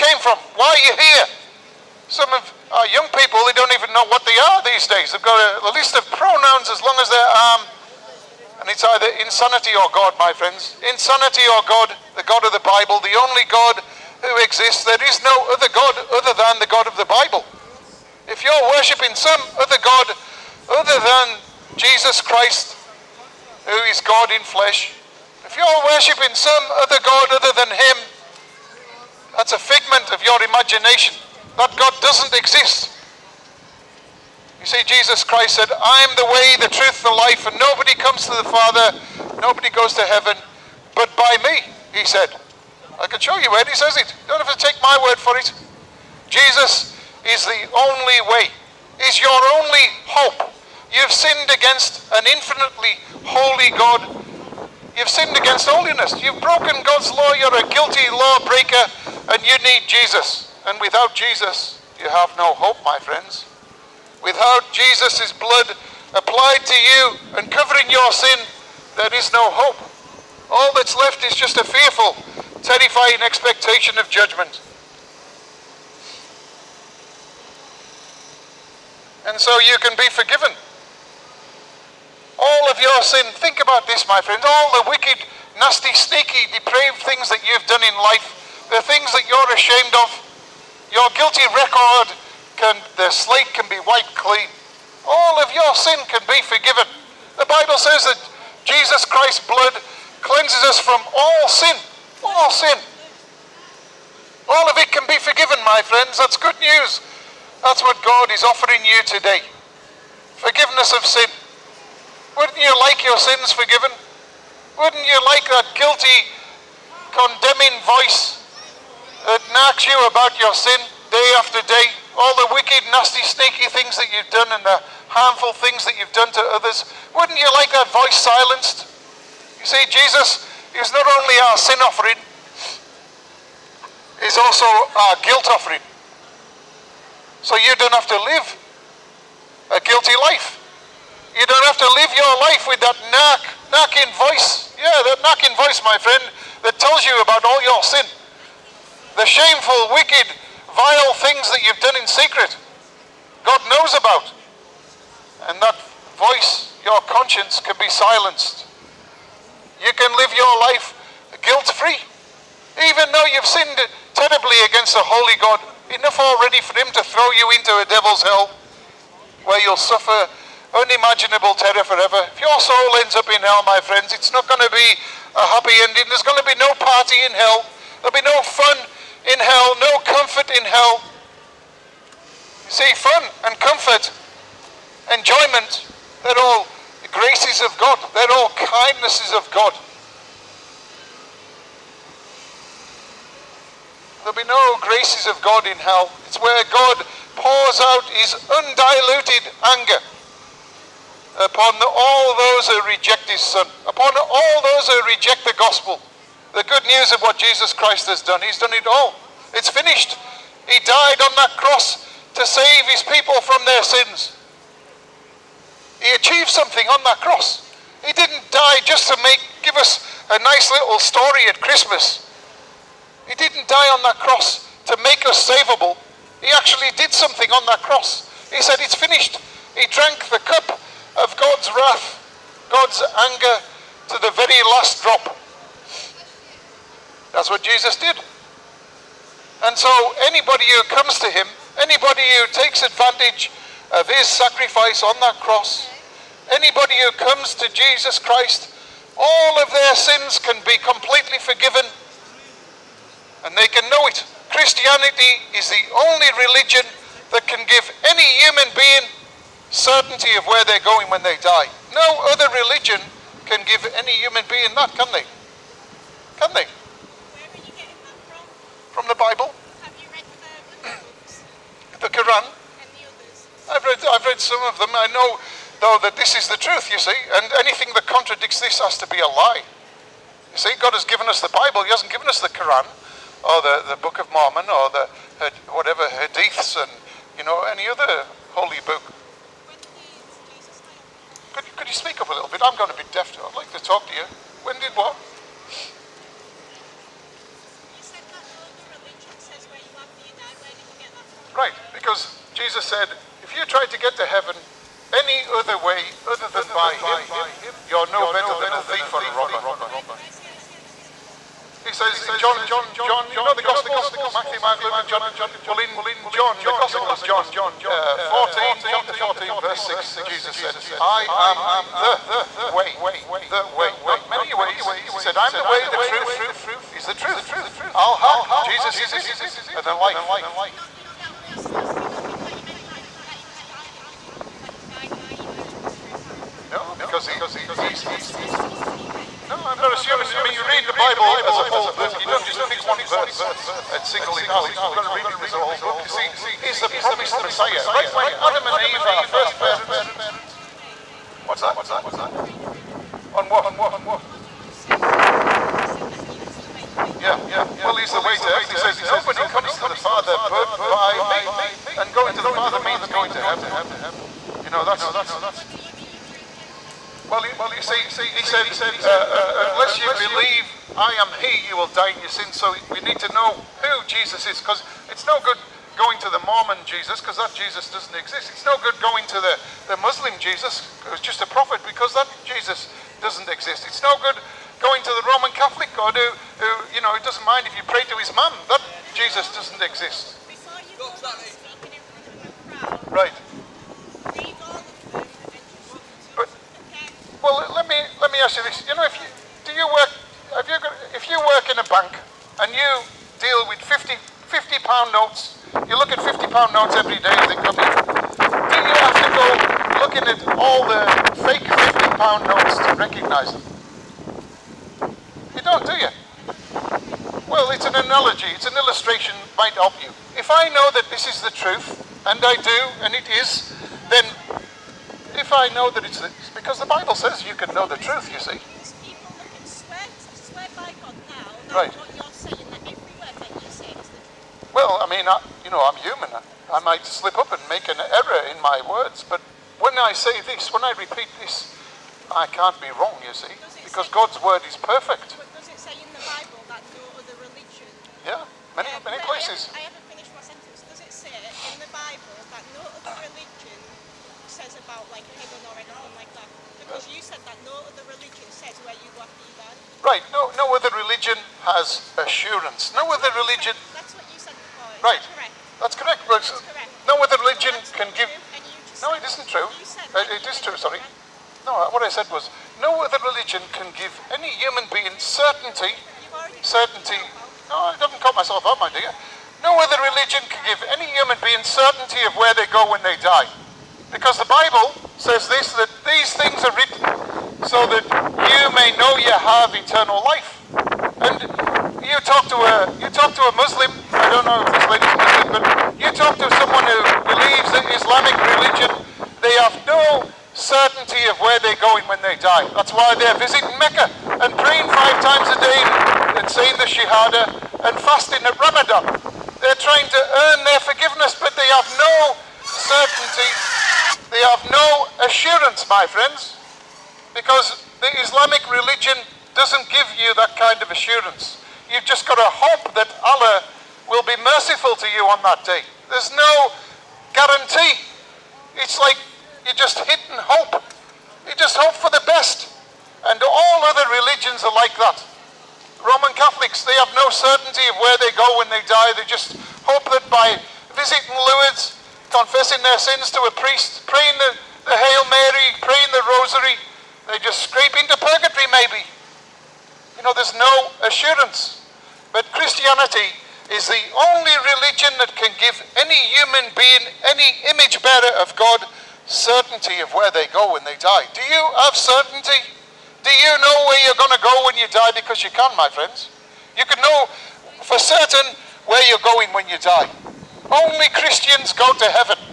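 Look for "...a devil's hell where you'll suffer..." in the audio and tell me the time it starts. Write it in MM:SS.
02:47.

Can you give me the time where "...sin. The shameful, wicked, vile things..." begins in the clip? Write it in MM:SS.
02:27.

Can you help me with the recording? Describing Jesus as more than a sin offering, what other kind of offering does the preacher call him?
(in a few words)
guilt offering.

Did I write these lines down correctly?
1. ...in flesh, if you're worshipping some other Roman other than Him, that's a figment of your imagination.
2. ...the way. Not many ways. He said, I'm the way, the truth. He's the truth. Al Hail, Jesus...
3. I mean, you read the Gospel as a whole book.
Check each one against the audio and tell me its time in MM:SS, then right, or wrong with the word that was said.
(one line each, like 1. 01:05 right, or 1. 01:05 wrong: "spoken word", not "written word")
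1. 00:24 wrong: "God", not "Roman"
2. 05:23 wrong: "Haq", not "Hail"
3. 05:40 wrong: "Bible", not "Gospel".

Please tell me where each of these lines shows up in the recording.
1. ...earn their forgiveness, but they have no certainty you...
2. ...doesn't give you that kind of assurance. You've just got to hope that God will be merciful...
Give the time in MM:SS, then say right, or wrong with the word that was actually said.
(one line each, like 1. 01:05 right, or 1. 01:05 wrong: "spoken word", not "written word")
1. 08:30 right
2. 08:39 wrong: "Allah", not "God".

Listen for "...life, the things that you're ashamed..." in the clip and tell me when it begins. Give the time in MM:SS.
01:28.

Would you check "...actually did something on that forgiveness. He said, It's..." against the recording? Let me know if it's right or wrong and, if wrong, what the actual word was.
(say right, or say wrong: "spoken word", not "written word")
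wrong: "cross", not "forgiveness".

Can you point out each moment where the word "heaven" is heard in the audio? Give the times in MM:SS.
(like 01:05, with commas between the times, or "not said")
00:40, 05:04, 05:58, 06:03, 07:35.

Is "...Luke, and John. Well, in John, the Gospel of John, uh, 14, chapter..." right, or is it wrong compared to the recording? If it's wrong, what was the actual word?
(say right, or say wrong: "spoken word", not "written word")
right.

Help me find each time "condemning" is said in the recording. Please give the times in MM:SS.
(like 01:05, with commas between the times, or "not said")
01:57.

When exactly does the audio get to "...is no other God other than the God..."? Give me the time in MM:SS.
00:15.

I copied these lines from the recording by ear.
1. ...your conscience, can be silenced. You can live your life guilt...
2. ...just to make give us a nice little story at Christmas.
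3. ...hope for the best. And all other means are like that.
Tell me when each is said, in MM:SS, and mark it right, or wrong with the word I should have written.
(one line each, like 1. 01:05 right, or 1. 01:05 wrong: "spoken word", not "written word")
1. 02:36 right
2. 03:38 right
3. 08:51 wrong: "religions", not "means".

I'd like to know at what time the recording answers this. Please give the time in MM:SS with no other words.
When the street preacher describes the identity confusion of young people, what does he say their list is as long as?
00:06.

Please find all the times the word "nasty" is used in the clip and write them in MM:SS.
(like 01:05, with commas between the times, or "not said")
01:25, 02:02.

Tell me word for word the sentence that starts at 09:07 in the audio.
They just scrape into purgatory, maybe.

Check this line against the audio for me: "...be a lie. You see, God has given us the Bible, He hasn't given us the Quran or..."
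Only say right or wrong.
right.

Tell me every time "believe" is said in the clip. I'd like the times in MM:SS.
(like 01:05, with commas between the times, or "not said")
06:10, 08:17.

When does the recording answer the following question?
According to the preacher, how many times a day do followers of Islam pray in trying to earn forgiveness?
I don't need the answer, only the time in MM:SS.
08:24.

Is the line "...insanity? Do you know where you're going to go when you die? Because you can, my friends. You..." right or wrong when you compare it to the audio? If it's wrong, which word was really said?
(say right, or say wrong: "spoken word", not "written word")
wrong: "certainty", not "insanity".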